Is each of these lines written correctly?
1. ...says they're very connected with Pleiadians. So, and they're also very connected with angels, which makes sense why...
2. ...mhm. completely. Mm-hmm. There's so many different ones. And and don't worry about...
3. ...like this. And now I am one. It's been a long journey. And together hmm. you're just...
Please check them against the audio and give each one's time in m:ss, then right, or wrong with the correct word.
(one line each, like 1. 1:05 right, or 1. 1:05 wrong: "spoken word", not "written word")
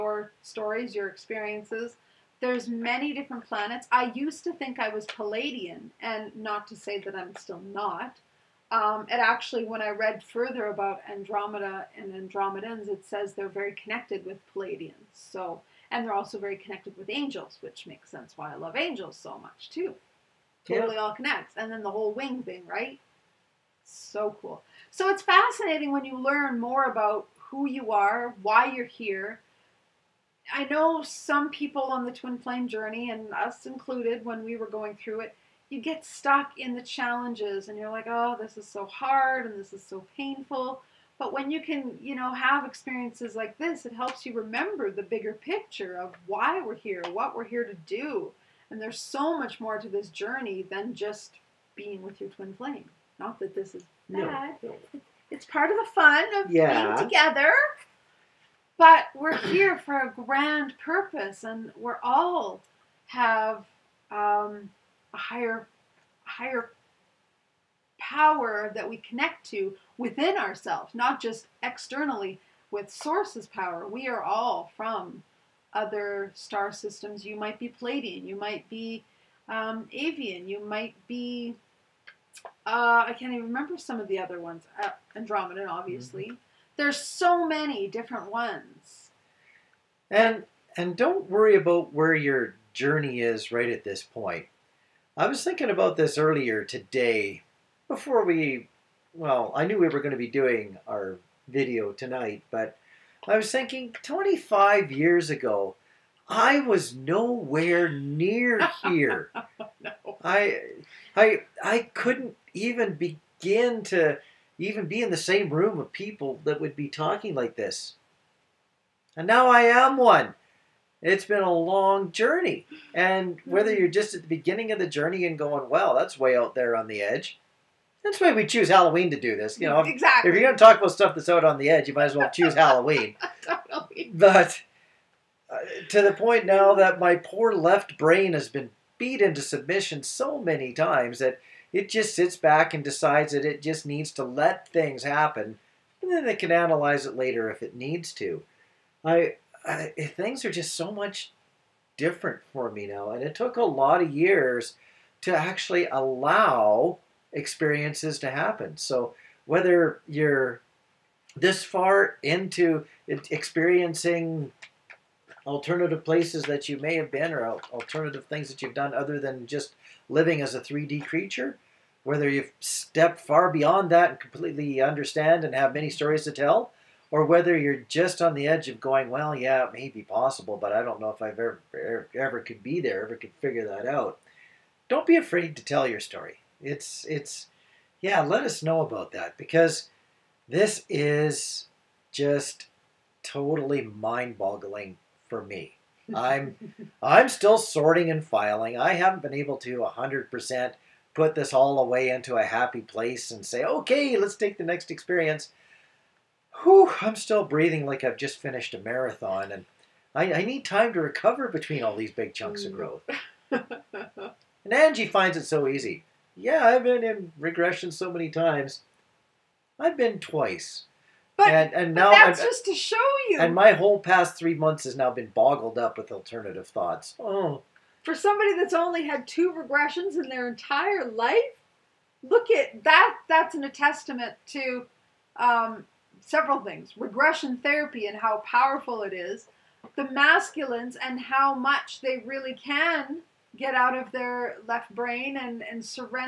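1. 0:13 right
2. 1:25 wrong: "obviously", not "completely"
3. 1:57 wrong: "whether", not "together".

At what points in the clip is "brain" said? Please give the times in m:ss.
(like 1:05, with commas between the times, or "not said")
2:17, 4:04.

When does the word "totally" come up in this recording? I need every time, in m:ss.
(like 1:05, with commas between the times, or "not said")
0:20, 2:13, 3:13.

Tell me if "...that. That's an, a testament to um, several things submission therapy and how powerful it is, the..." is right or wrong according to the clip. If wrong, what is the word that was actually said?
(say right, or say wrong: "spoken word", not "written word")
wrong: "regression", not "submission".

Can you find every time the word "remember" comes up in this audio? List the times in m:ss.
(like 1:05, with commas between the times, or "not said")
0:44, 1:23.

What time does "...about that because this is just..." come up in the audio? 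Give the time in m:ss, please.
3:08.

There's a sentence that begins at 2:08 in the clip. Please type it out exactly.
That's why we choose Halloween to do this.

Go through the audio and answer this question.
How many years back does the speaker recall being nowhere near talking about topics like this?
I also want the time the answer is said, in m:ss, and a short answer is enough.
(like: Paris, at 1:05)
25, at 1:44.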